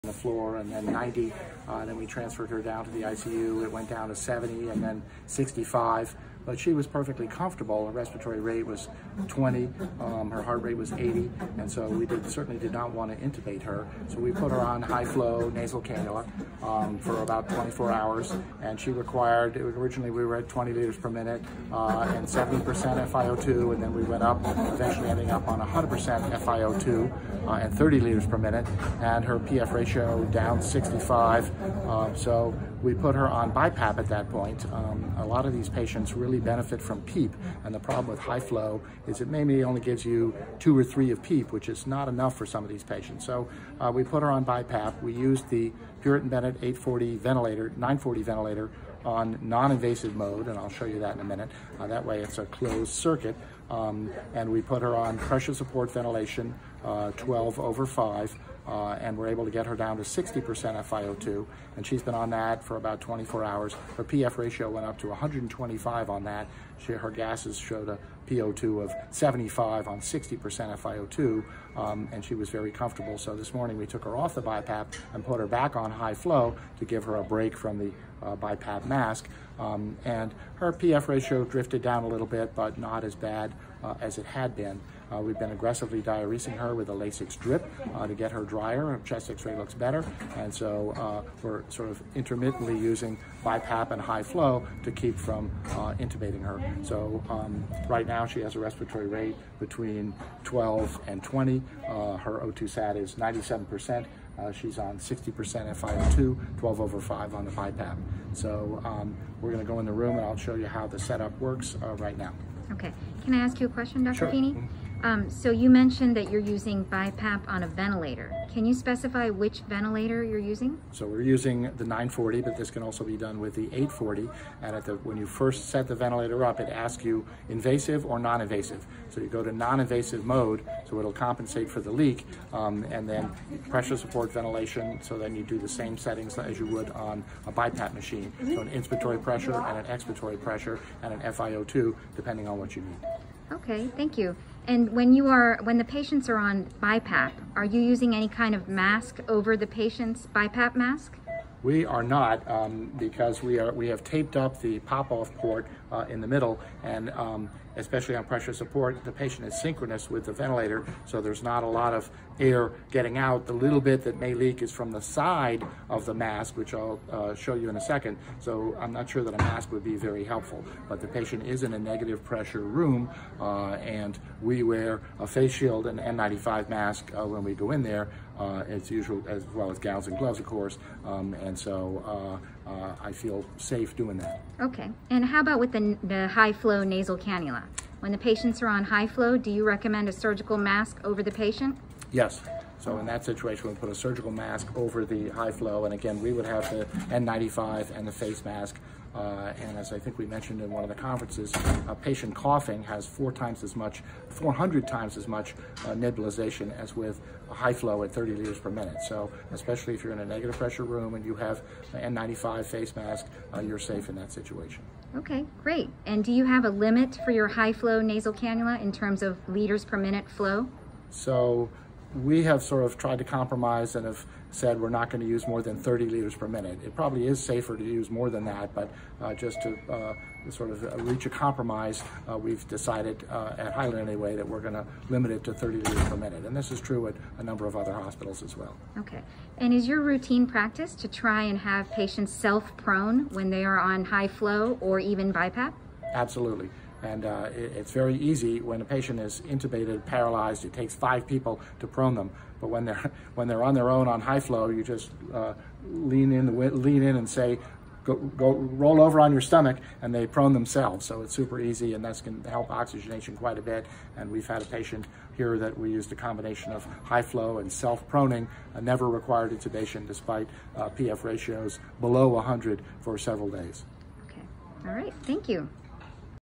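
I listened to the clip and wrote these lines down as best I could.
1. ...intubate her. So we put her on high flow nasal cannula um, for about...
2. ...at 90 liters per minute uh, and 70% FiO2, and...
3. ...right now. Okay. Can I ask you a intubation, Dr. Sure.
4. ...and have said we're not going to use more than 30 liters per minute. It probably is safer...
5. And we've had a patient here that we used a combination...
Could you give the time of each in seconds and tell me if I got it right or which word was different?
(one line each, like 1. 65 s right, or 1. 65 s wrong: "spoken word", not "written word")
1. 13 s right
2. 20 s wrong: "20", not "90"
3. 111 s wrong: "question", not "intubation"
4. 223 s right
5. 264 s right.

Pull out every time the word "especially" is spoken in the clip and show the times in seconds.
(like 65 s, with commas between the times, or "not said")
157 s, 209 s.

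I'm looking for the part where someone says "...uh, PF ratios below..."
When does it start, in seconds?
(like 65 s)
270 s.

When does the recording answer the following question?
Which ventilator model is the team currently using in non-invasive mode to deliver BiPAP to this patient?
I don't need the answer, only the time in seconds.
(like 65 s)
120 s.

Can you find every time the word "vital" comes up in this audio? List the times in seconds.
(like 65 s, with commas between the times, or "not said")
not said.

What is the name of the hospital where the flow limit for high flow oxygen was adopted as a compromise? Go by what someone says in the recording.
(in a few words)
Highland.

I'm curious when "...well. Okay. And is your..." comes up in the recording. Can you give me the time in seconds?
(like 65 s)
238 s.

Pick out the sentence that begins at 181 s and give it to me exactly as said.
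Um, and and so uh, uh, I feel safe doing that.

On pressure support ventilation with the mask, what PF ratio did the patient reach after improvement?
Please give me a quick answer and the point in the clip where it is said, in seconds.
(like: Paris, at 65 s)
125, at 65 s.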